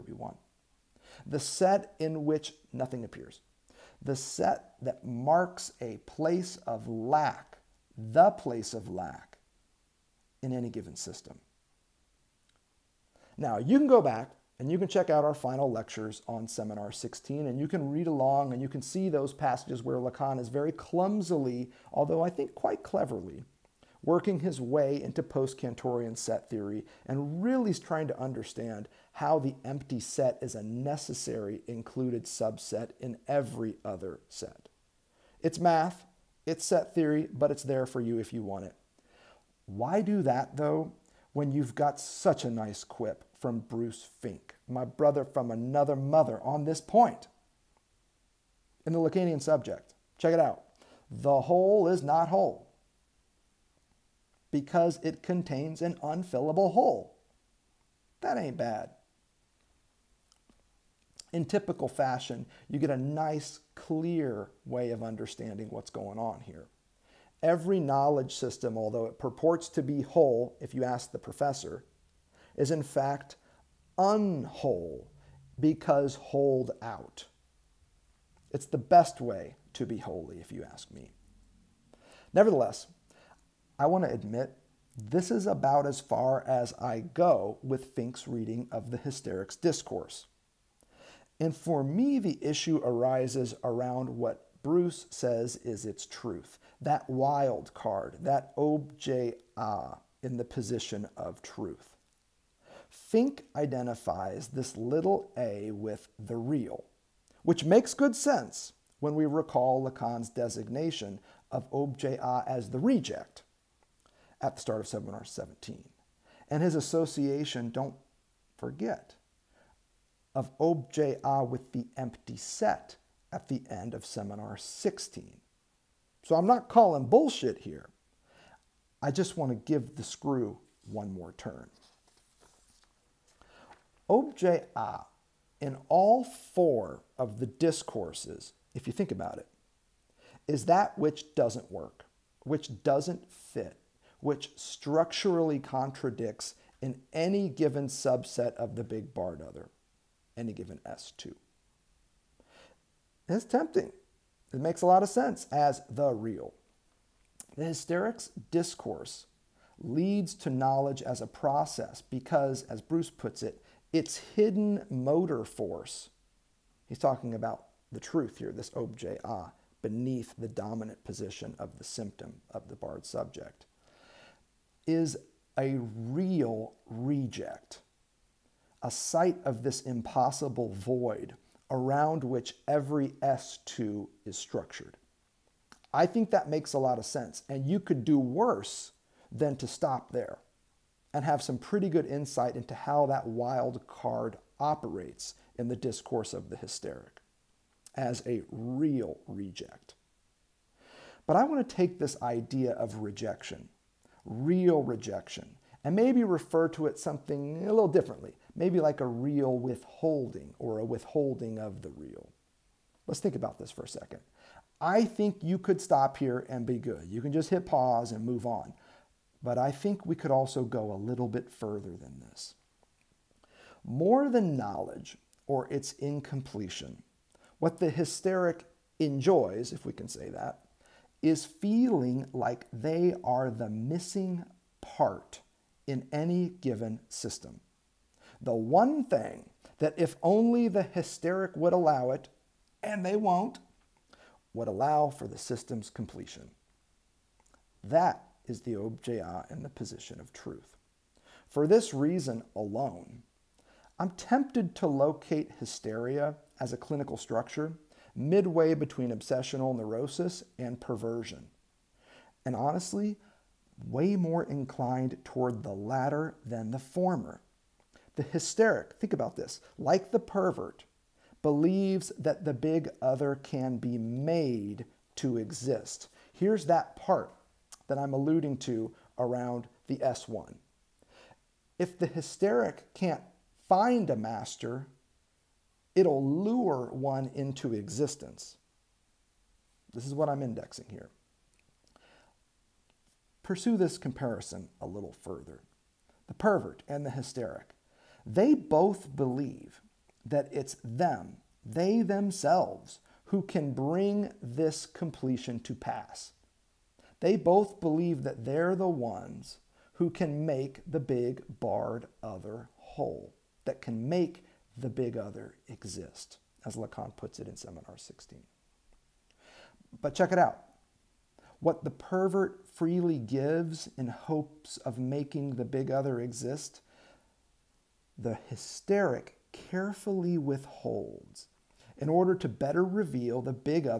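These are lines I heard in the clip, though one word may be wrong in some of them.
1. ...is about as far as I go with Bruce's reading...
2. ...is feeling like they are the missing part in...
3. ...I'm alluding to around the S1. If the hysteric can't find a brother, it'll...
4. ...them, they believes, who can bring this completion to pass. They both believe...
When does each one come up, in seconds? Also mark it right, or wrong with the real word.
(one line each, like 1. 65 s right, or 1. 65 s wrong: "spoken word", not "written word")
1. 85 s wrong: "Fink", not "Bruce"
2. 231 s right
3. 277 s wrong: "master", not "brother"
4. 300 s wrong: "themselves", not "believes".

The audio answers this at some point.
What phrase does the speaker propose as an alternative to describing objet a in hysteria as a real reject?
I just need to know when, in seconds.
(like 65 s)
208 s.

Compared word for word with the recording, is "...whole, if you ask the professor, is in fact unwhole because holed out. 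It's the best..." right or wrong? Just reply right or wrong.
right.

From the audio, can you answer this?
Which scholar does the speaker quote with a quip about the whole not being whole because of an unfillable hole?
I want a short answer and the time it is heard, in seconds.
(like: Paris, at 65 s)
Bruce Fink, at 43 s.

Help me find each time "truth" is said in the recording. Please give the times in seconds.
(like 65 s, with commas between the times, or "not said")
96 s, 101 s, 167 s, 250 s.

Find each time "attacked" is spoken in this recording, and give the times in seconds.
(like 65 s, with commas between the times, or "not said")
not said.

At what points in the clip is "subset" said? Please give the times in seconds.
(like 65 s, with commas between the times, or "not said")
32 s, 147 s.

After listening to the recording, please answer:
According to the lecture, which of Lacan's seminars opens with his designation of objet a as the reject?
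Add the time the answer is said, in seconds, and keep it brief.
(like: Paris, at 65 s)
Seminar 17, at 114 s.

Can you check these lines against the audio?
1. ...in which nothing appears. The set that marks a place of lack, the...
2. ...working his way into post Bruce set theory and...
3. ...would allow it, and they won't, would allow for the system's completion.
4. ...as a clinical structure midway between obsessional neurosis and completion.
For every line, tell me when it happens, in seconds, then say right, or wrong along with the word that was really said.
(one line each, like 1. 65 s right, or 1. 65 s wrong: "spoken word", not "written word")
1. 1 s right
2. 24 s wrong: "Cantorian", not "Bruce"
3. 241 s right
4. 256 s wrong: "perversion", not "completion".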